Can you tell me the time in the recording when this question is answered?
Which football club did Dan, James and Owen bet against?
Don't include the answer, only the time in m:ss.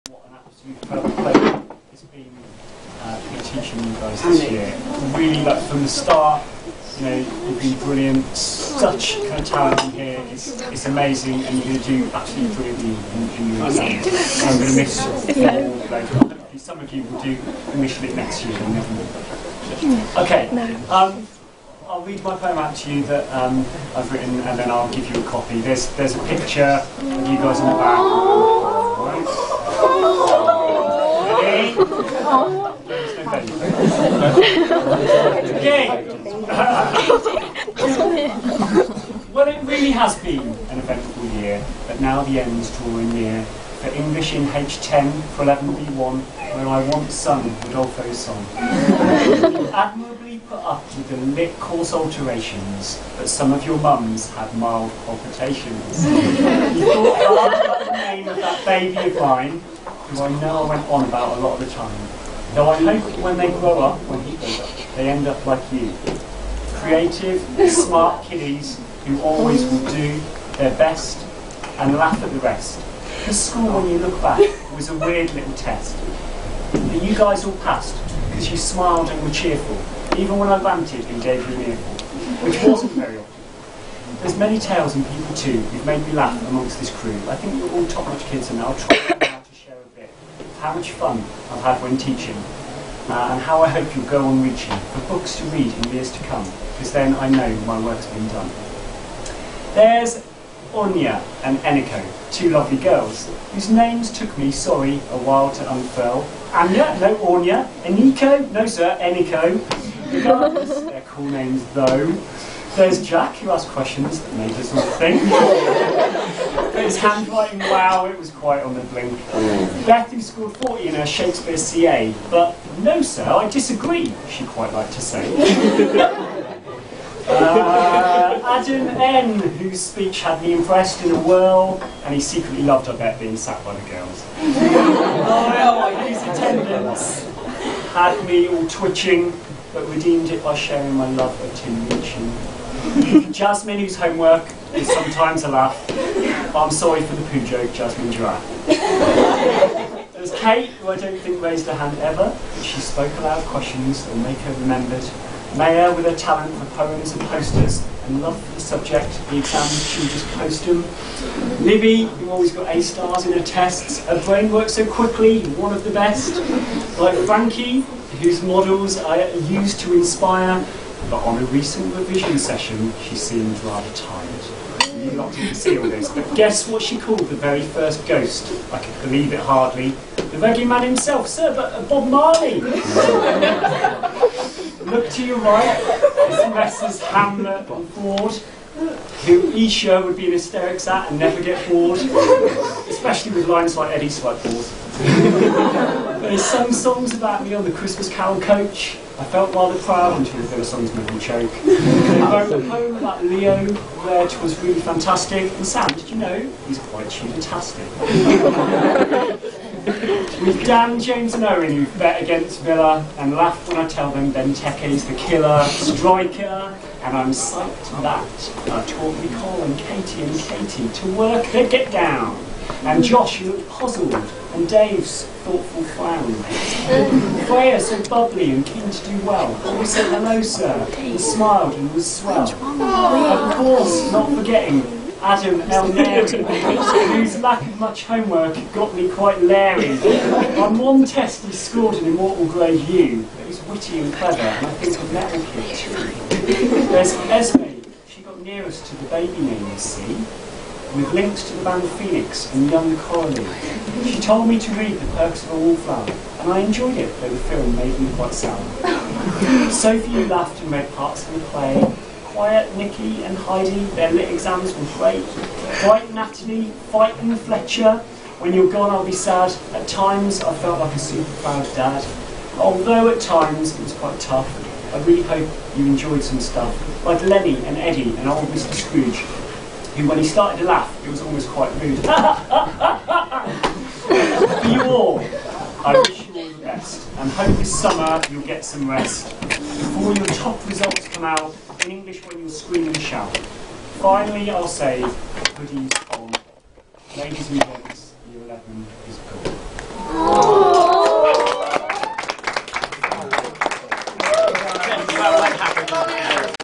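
3:32.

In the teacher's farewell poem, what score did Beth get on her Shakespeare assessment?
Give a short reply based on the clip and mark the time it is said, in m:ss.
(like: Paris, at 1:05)
40, at 2:00.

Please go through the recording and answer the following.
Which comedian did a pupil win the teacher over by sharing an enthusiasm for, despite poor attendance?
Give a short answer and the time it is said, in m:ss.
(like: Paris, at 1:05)
Tim Minchin, at 2:21.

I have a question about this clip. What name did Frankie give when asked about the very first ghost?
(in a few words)
Bob Marley.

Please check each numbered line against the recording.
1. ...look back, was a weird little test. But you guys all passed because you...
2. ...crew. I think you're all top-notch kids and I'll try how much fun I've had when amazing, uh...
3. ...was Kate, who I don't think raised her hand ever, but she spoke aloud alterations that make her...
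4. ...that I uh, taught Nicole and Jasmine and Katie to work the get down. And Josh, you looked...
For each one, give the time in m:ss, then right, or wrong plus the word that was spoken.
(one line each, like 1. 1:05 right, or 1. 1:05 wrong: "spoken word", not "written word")
1. 1:13 right
2. 1:26 wrong: "teaching", not "amazing"
3. 2:30 wrong: "questions", not "alterations"
4. 3:38 wrong: "Katie", not "Jasmine".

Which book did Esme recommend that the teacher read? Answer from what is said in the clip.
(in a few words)
The Perks of a Wallflower.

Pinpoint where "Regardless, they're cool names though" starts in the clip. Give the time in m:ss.
1:50.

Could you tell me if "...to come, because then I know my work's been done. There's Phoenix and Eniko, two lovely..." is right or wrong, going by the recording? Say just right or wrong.
wrong.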